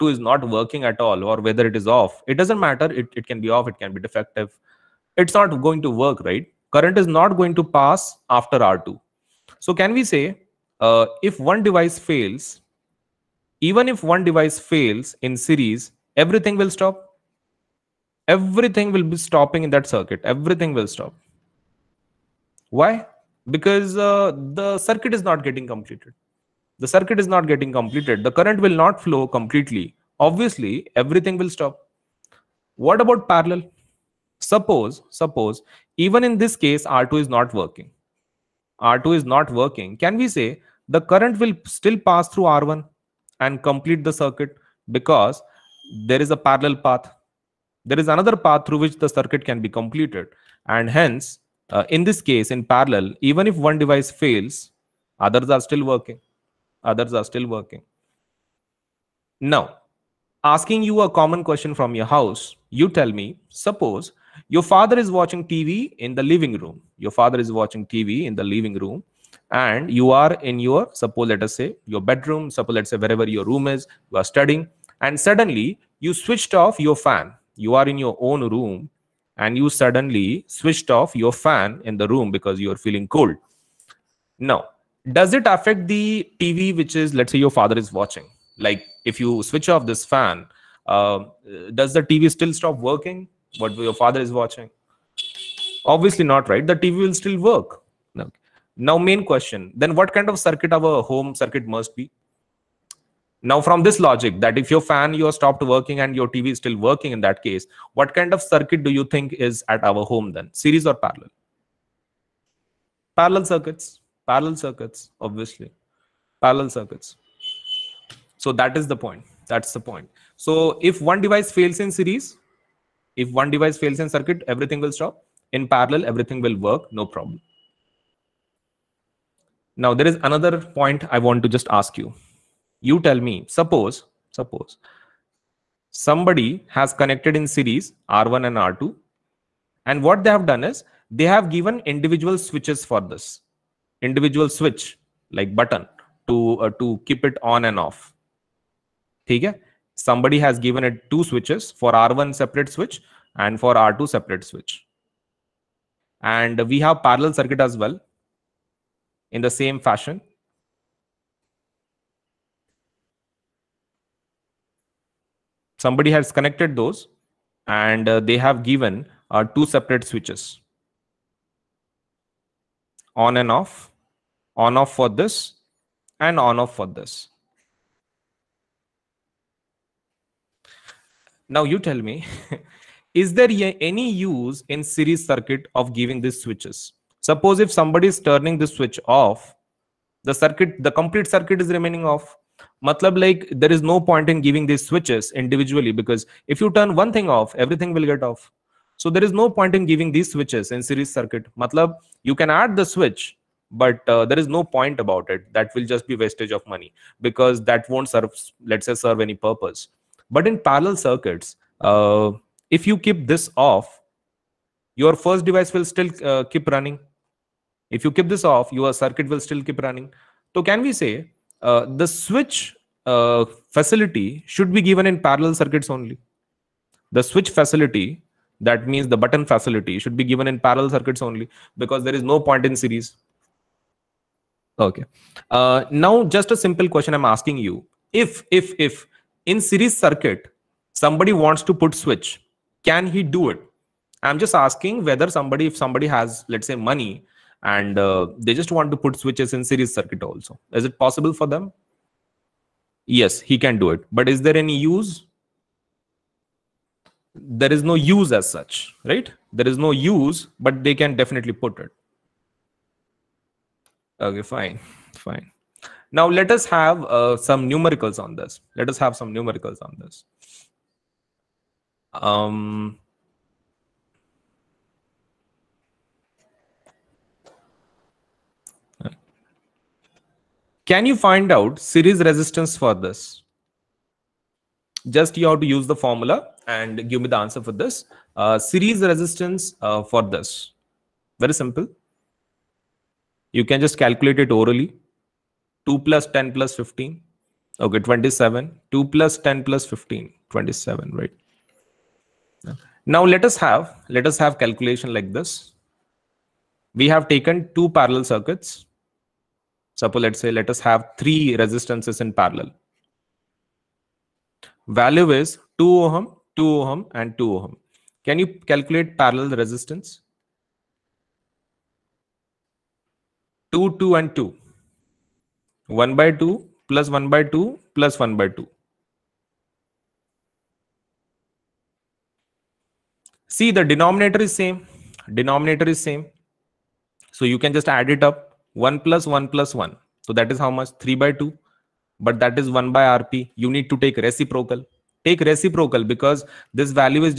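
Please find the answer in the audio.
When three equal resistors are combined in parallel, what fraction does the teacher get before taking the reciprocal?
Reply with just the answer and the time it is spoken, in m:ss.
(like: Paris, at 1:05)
3/2, at 5:40.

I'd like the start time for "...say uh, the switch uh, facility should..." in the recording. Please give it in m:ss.
3:40.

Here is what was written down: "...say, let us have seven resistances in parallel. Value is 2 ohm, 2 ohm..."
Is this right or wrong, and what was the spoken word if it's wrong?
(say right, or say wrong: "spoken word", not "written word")
wrong: "three", not "seven".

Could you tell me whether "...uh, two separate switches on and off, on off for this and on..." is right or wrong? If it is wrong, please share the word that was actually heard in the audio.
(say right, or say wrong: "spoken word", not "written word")
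right.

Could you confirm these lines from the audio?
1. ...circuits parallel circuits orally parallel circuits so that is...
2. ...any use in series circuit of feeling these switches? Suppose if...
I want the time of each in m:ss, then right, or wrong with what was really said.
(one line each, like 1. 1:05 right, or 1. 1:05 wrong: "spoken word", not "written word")
1. 1:53 wrong: "obviously", not "orally"
2. 3:03 wrong: "giving", not "feeling".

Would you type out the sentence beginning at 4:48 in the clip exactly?
Uh, series resistance uh, for this.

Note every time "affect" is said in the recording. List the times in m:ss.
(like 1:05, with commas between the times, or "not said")
1:25.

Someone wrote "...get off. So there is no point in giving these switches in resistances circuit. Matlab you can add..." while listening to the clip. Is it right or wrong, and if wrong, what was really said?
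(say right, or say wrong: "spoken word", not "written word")
wrong: "series", not "resistances".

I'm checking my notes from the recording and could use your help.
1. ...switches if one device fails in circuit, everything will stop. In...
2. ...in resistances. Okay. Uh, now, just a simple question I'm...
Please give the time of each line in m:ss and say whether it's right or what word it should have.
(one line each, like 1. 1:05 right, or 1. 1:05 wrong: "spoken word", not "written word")
1. 2:01 wrong: "series", not "switches"
2. 3:52 wrong: "series", not "resistances".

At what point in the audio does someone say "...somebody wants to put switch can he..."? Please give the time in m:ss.
4:01.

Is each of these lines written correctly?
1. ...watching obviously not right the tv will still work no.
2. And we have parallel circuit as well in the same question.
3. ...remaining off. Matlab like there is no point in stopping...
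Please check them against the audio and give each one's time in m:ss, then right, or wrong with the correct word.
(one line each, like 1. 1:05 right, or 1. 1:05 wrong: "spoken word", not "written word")
1. 1:34 right
2. 2:36 wrong: "fashion", not "question"
3. 3:11 wrong: "giving", not "stopping".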